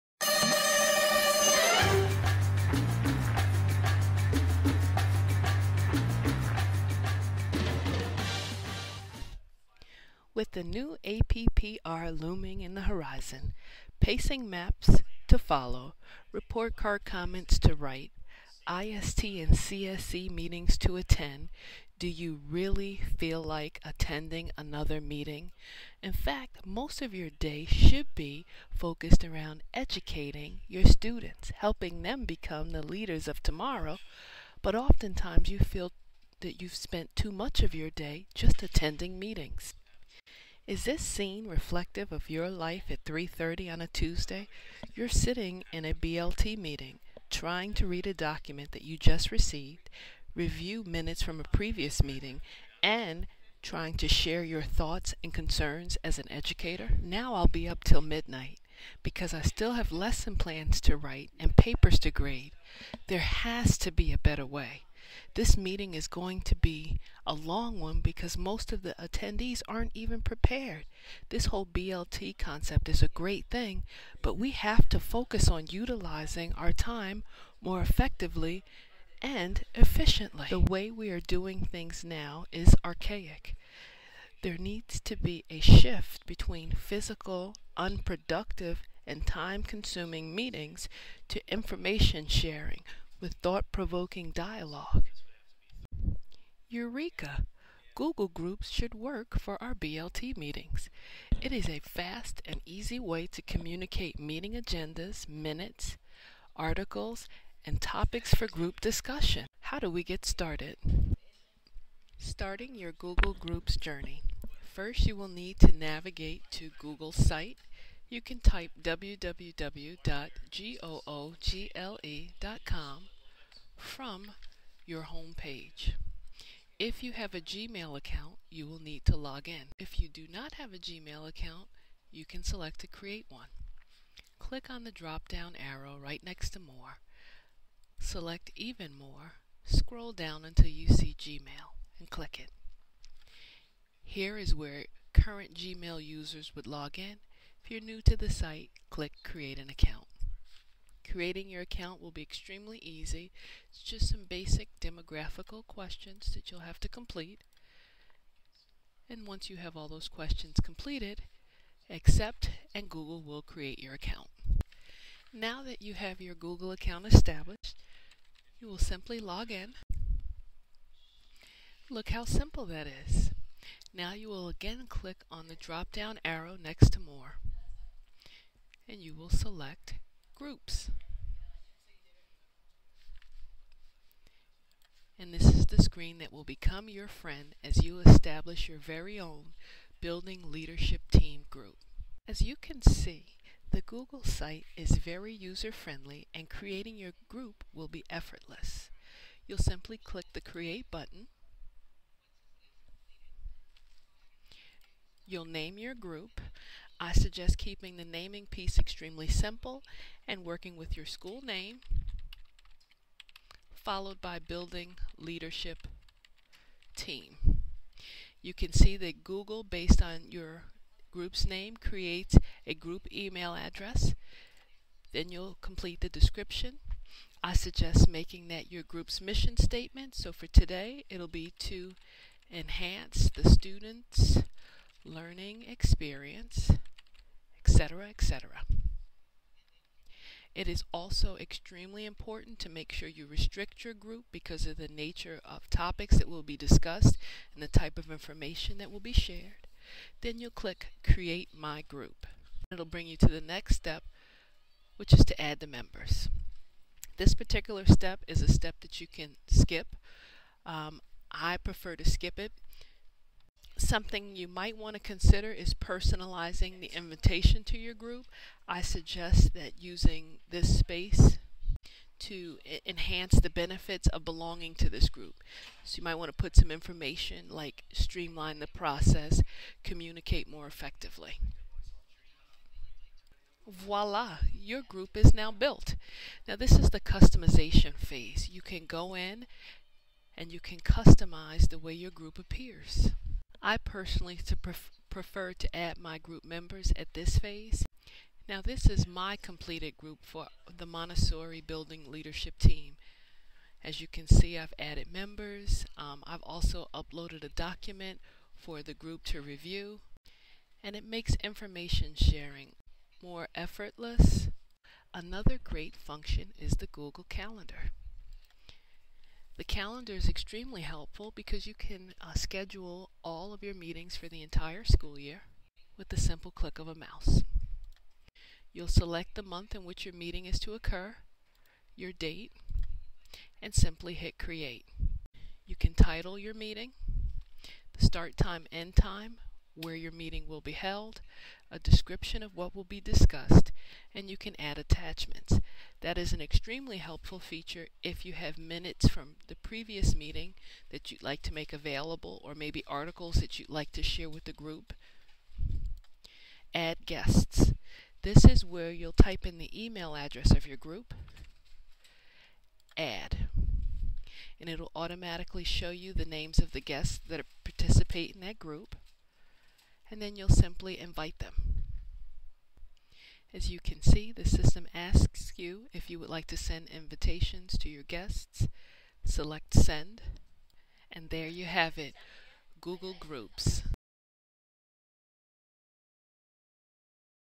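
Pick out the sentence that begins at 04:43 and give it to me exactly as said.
Voila, your group is now built.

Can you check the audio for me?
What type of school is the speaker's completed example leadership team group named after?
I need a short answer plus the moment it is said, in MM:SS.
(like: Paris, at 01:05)
Montessori, at 05:00.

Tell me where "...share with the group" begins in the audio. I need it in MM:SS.
05:54.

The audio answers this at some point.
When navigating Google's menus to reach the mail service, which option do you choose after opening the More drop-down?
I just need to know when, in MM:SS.
02:18.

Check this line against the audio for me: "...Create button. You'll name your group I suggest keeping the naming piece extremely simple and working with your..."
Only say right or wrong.
right.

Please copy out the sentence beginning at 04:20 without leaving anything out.
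Um, I prefer to skip it something you might want to consider is personalizing the invitation to your group.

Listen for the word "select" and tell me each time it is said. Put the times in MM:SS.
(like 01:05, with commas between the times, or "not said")
02:12, 02:17, 02:59, 05:28, 06:19.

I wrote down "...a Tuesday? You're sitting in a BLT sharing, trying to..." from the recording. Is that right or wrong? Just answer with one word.
wrong.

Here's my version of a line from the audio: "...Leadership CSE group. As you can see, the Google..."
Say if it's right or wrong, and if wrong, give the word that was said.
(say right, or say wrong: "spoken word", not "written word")
wrong: "Team", not "CSE".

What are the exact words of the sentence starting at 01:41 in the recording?
It is a fast and easy way to communicate meeting agendas, minutes, articles, and topics for group discussion.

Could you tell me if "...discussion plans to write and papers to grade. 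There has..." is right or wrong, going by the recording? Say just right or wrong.
wrong.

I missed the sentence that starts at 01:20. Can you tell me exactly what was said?
The way we are doing things now is archaic.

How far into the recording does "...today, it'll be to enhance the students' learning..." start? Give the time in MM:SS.
03:50.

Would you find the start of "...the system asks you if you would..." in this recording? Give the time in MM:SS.
06:14.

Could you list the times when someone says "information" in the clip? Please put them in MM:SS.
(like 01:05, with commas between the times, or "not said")
01:31, 04:08, 04:36, 05:11.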